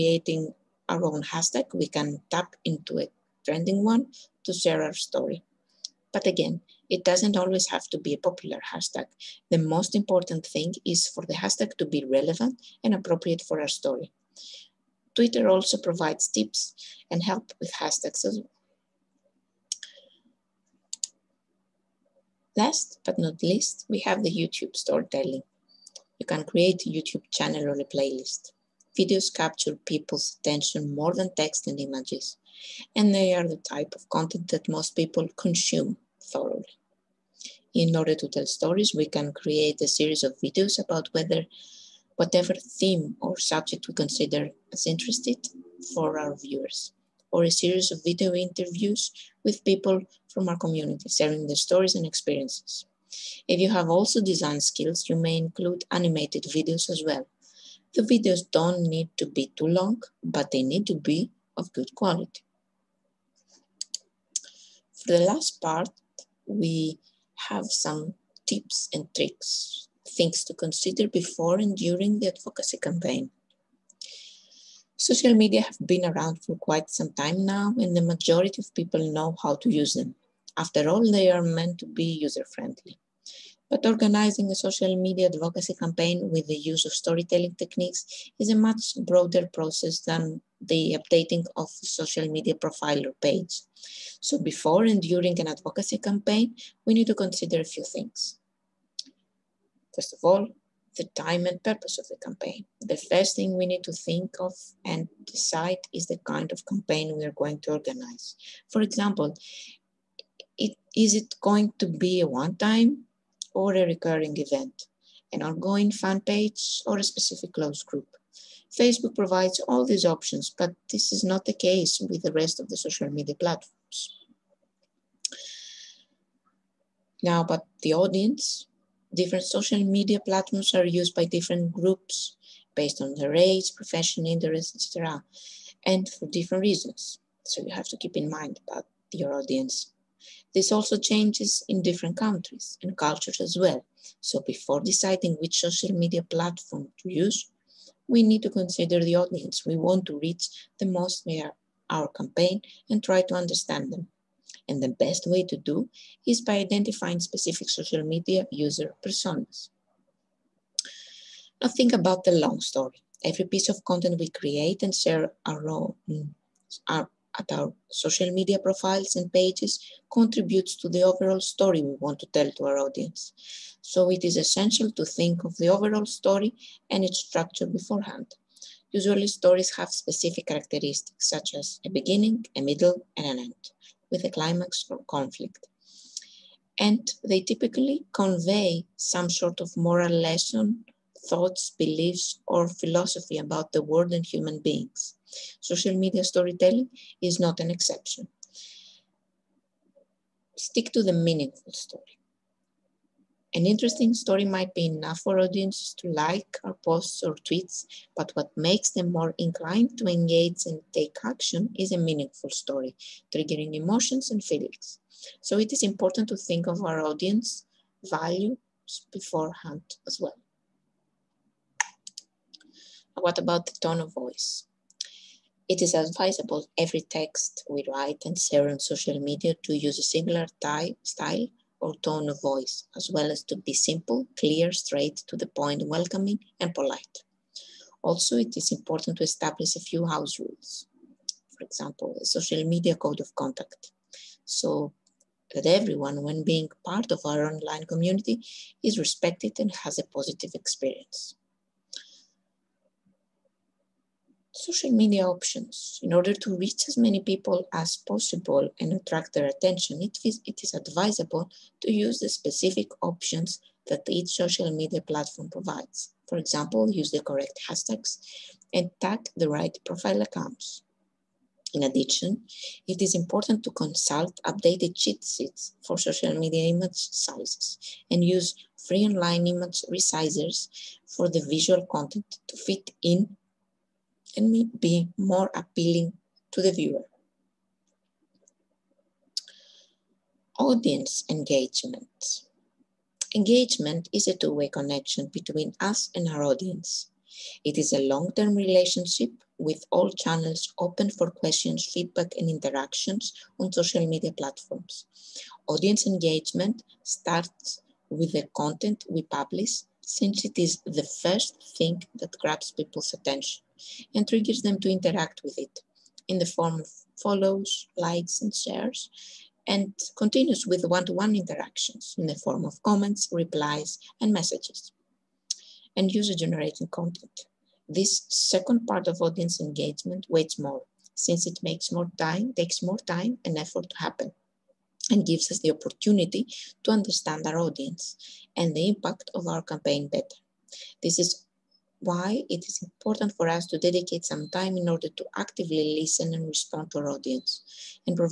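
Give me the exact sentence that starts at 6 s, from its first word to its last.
But again, it doesn't always have to be a popular hashtag.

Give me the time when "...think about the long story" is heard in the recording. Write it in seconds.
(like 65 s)
161 s.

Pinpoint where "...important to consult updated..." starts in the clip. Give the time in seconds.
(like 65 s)
273 s.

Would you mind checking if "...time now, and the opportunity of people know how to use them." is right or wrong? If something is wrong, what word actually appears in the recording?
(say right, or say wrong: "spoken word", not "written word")
wrong: "majority", not "opportunity".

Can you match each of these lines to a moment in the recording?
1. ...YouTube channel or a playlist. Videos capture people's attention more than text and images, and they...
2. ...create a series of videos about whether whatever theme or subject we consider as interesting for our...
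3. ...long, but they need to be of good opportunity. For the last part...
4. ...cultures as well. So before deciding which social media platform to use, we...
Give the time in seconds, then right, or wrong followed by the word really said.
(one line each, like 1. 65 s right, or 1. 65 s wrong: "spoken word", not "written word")
1. 26 s right
2. 39 s right
3. 59 s wrong: "quality", not "opportunity"
4. 142 s right.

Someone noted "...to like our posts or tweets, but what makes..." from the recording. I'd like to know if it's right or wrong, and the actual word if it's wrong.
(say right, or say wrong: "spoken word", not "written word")
right.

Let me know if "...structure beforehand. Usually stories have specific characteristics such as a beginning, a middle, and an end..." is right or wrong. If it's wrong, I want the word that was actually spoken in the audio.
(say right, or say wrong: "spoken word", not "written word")
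right.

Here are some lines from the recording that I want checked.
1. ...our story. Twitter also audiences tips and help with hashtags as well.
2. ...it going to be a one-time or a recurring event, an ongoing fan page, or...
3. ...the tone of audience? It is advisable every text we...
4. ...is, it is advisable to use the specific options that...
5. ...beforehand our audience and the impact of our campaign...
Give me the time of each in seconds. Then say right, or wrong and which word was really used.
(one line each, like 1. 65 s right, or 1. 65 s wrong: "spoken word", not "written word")
1. 13 s wrong: "provides", not "audiences"
2. 111 s right
3. 223 s wrong: "voice", not "audience"
4. 260 s right
5. 336 s wrong: "understand", not "beforehand".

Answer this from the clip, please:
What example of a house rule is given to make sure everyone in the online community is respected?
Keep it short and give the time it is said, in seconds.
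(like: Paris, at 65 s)
A social media code of conduct, at 242 s.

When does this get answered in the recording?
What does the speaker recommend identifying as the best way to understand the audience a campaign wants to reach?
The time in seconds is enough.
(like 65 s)
157 s.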